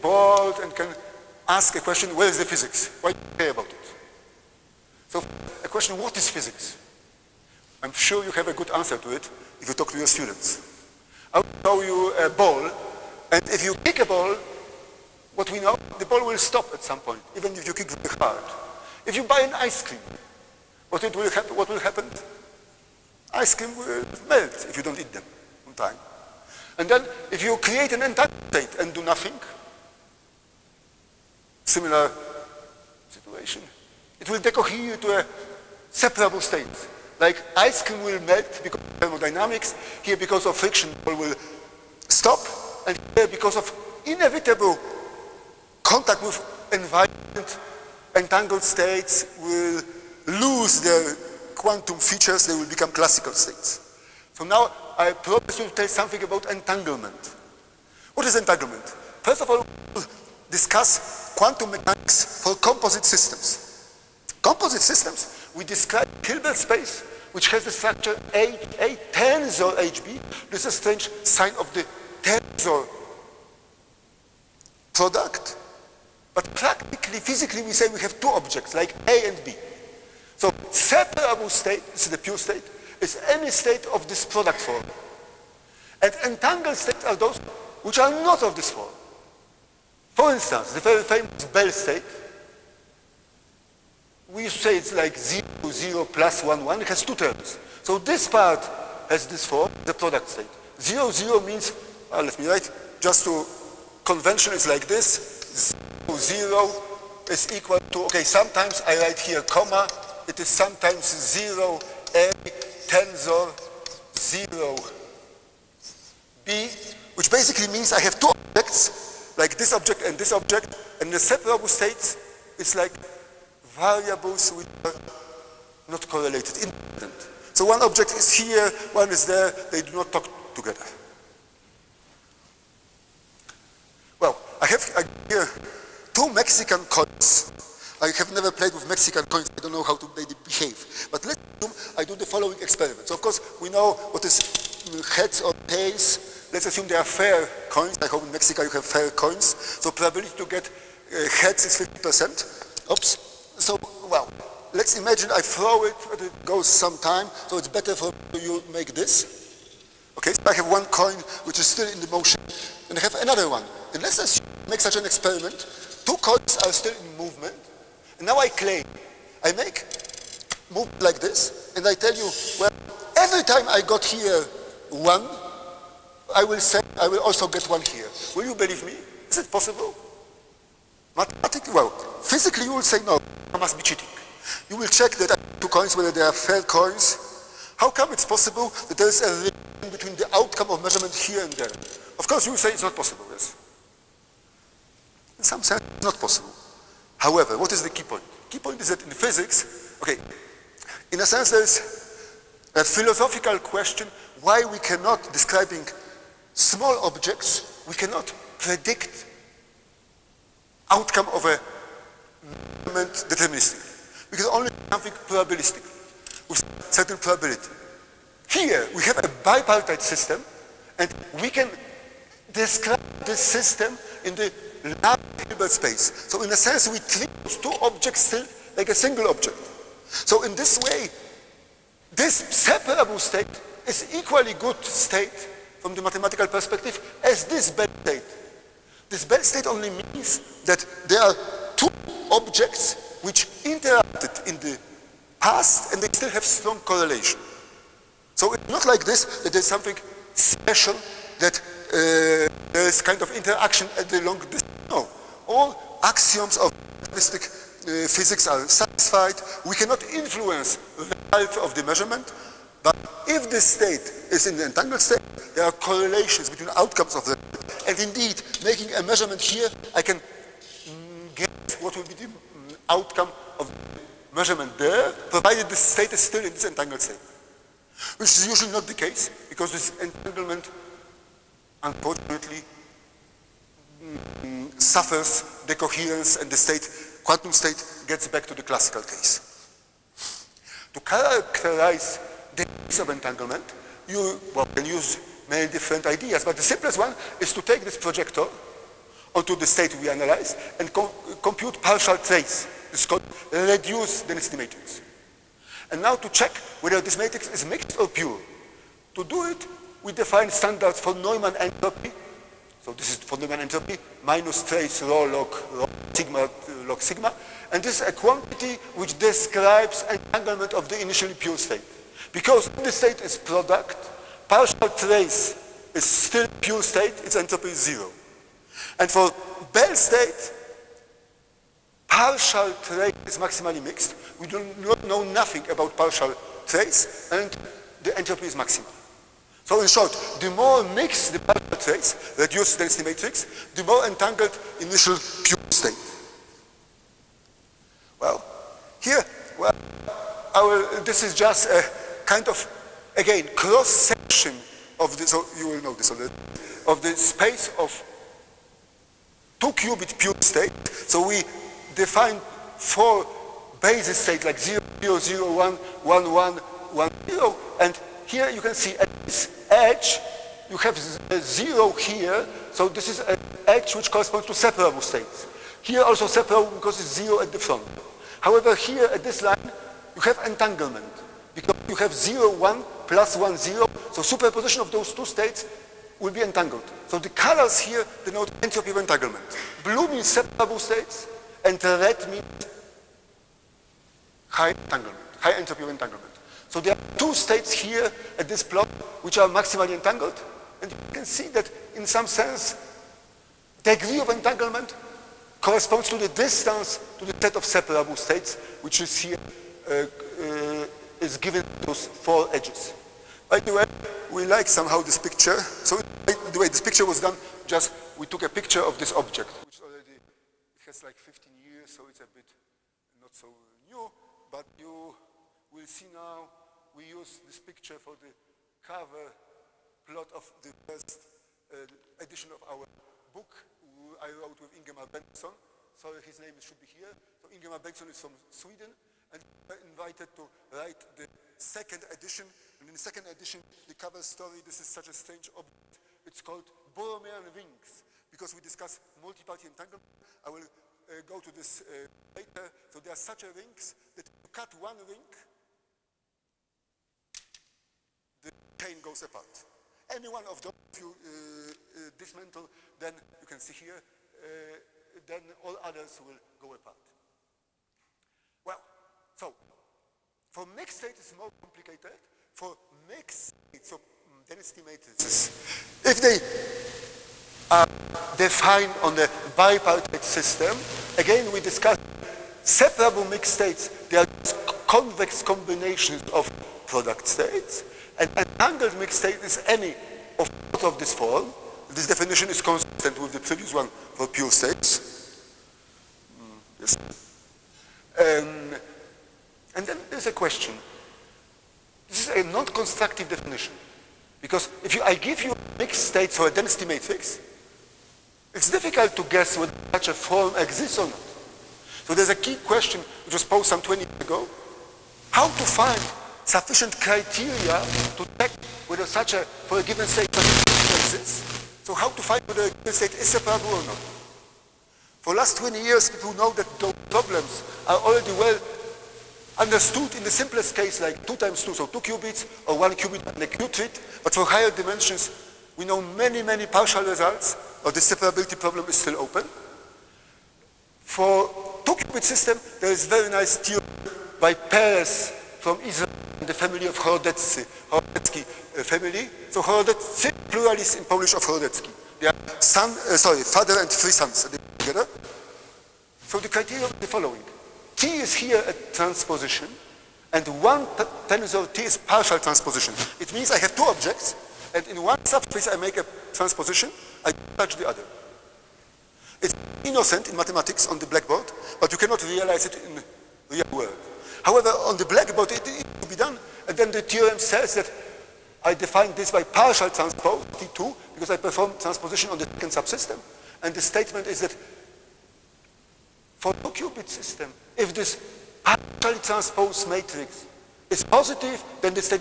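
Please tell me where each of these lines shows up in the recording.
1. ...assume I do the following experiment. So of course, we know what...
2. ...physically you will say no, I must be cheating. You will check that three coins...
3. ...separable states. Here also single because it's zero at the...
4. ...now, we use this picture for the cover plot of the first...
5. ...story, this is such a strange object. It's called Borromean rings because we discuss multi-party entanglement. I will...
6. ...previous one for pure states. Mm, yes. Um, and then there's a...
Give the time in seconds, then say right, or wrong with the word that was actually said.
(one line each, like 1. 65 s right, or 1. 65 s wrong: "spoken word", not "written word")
1. 141 s right
2. 182 s wrong: "two", not "three"
3. 374 s wrong: "separable", not "single"
4. 426 s right
5. 444 s right
6. 493 s right.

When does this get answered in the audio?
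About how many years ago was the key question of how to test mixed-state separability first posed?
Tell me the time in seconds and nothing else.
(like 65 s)
513 s.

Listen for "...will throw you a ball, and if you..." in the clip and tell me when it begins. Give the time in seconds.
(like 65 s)
11 s.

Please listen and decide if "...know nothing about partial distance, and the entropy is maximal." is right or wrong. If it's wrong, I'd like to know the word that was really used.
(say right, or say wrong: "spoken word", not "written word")
wrong: "trace", not "distance".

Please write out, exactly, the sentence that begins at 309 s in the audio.
To do it, we define standards von Neumann entropy.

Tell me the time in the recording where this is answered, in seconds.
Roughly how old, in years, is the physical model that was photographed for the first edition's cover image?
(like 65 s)
421 s.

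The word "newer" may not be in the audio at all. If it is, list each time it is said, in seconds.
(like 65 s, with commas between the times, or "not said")
not said.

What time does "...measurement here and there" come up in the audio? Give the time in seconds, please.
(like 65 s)
190 s.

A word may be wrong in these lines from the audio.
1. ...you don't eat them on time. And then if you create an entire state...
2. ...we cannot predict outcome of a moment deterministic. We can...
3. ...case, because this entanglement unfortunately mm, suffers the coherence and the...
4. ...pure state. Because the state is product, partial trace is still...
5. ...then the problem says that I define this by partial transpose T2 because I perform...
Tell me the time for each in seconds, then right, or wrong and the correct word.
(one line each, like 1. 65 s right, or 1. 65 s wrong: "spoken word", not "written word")
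1. 24 s right
2. 207 s right
3. 278 s right
4. 321 s right
5. 576 s wrong: "theorem", not "problem".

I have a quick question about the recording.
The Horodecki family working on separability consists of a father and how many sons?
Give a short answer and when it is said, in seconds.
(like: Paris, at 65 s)
3, at 553 s.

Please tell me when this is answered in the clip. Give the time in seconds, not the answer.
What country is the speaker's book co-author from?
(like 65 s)
438 s.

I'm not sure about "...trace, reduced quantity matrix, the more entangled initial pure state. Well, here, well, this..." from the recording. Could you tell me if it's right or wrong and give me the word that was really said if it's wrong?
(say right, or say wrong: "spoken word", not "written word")
wrong: "density", not "quantity".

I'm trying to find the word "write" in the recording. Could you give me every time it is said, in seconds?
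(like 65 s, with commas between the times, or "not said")
102 s, 108 s, 440 s.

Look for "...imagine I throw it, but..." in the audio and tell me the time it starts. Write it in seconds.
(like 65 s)
154 s.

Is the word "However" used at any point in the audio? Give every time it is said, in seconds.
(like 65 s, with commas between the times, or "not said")
197 s, 378 s, 574 s.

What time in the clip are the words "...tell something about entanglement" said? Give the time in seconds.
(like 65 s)
55 s.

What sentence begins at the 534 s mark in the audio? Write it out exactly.
But for higher dimensions, we know many, many partial results, of the separability problem is still open.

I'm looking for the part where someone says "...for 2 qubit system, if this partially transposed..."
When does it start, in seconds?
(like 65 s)
586 s.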